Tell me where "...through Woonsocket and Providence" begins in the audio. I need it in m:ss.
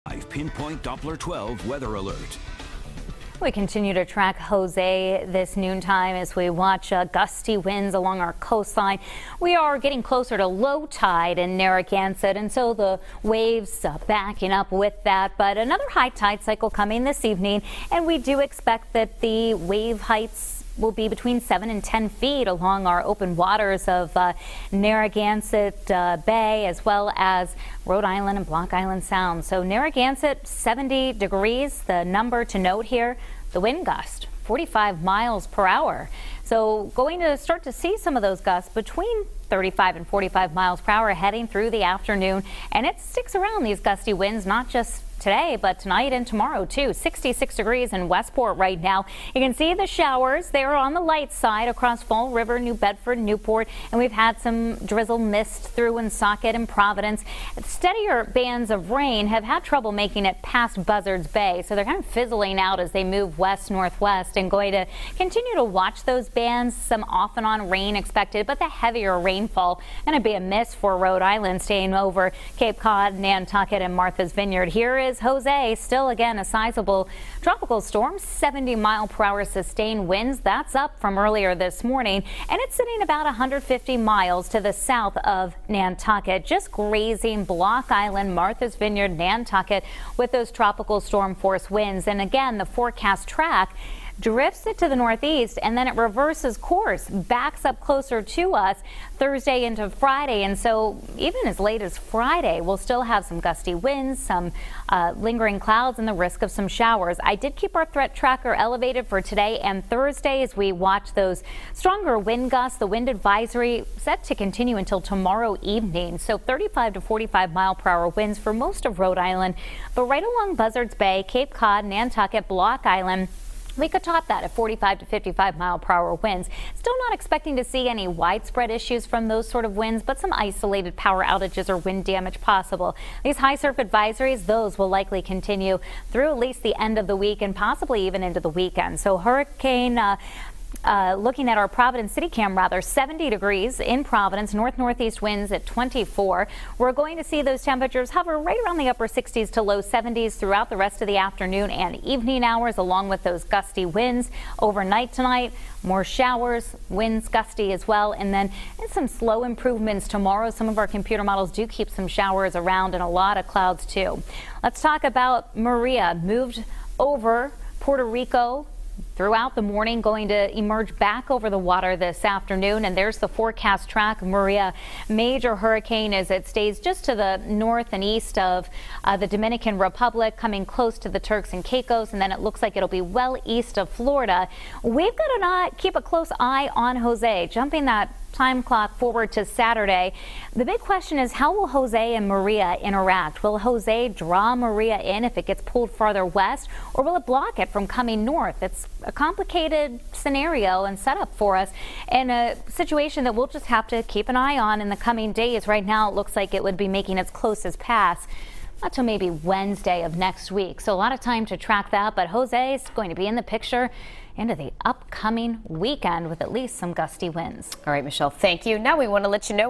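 0:55.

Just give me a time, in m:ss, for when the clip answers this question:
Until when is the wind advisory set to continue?
1:54.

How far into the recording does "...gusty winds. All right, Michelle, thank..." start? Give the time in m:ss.
3:36.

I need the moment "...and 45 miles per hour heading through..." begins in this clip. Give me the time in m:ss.
0:39.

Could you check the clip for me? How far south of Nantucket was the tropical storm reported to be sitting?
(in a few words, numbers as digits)
150 miles.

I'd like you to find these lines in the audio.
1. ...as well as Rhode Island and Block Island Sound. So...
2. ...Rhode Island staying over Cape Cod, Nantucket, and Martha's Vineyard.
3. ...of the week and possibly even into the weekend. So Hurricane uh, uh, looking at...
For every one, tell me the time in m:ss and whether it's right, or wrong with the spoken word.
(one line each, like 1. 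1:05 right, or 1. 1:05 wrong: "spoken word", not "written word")
1. 0:26 right
2. 1:10 right
3. 2:16 right.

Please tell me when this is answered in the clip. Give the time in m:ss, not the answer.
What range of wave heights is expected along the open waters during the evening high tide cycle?
0:21.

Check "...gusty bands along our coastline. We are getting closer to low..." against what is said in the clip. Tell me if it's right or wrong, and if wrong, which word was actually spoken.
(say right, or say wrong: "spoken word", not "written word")
wrong: "winds", not "bands".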